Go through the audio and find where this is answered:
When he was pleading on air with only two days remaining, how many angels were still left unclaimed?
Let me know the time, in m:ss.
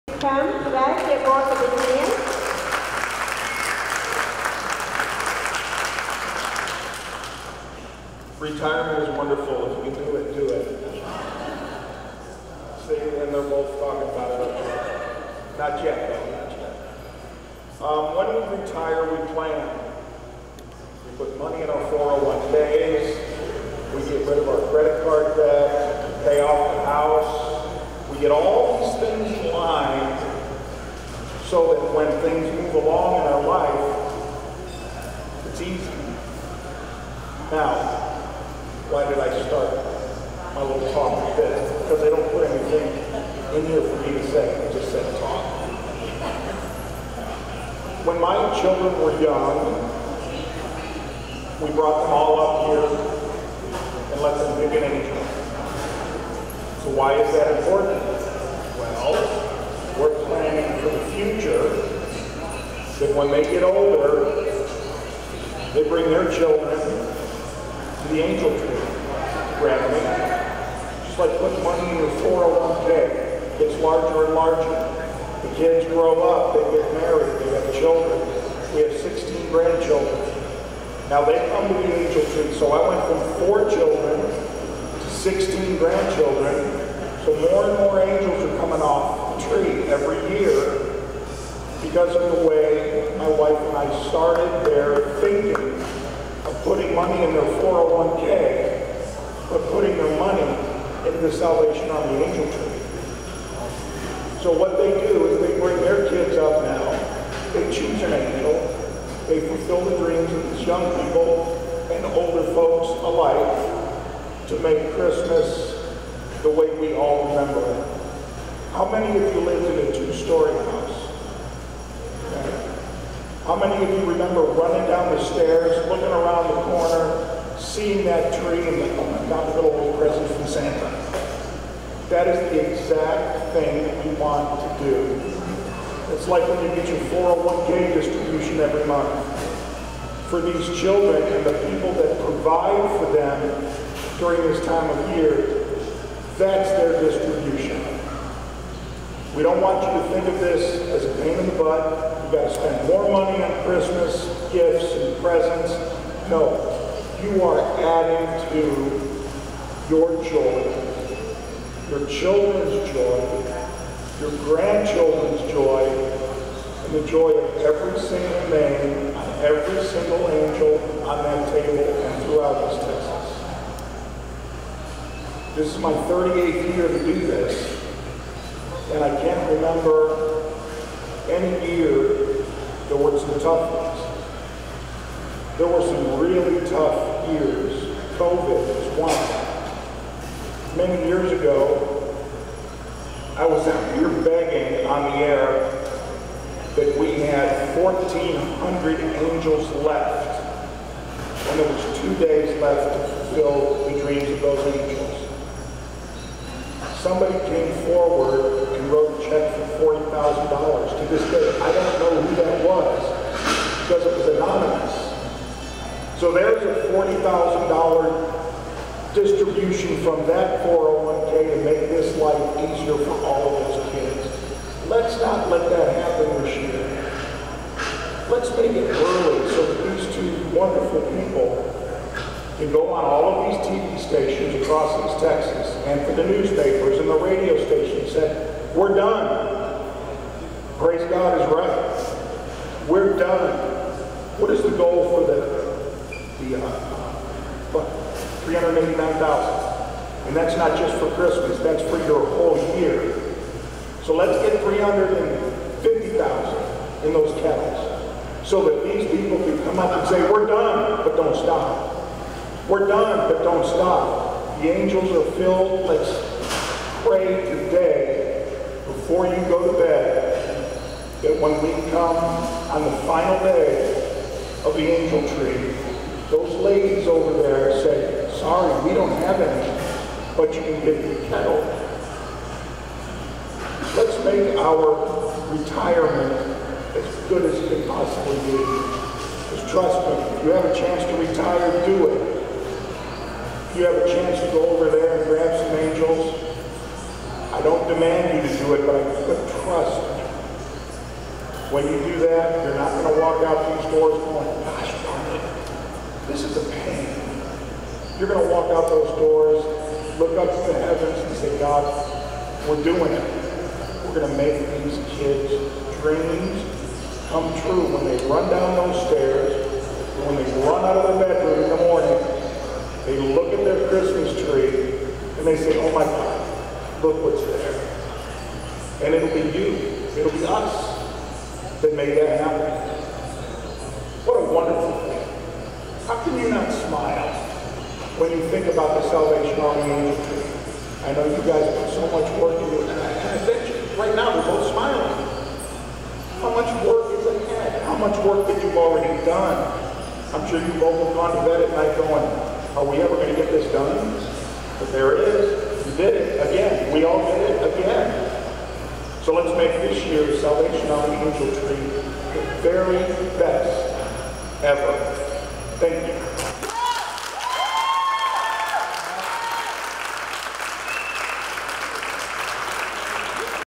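3:17.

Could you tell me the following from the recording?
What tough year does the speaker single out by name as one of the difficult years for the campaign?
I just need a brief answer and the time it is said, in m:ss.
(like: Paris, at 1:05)
COVID, at 3:08.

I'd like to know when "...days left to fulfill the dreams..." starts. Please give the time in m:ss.
3:22.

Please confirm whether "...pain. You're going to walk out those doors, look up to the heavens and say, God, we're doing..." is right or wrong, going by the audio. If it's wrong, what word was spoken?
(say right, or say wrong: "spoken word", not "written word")
right.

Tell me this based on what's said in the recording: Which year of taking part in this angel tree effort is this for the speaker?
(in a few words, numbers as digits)
38th.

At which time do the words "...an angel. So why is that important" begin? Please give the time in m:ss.
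0:54.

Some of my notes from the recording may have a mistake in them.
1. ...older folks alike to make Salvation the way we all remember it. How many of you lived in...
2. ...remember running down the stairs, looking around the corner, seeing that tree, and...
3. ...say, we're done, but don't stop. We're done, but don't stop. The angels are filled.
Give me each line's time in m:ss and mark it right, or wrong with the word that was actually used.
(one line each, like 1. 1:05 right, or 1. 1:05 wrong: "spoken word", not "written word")
1. 1:52 wrong: "Christmas", not "Salvation"
2. 2:04 right
3. 4:20 right.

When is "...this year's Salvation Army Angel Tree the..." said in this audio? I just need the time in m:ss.
5:59.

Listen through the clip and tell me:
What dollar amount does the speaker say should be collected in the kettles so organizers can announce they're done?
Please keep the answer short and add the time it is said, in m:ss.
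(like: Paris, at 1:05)
350,000, at 4:14.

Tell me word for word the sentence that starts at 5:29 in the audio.
And it'll be you, it'll be us that made that happen.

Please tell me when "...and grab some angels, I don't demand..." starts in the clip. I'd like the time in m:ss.
4:55.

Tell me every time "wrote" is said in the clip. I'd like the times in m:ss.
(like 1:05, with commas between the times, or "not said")
3:28.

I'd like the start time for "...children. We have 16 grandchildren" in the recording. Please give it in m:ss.
1:17.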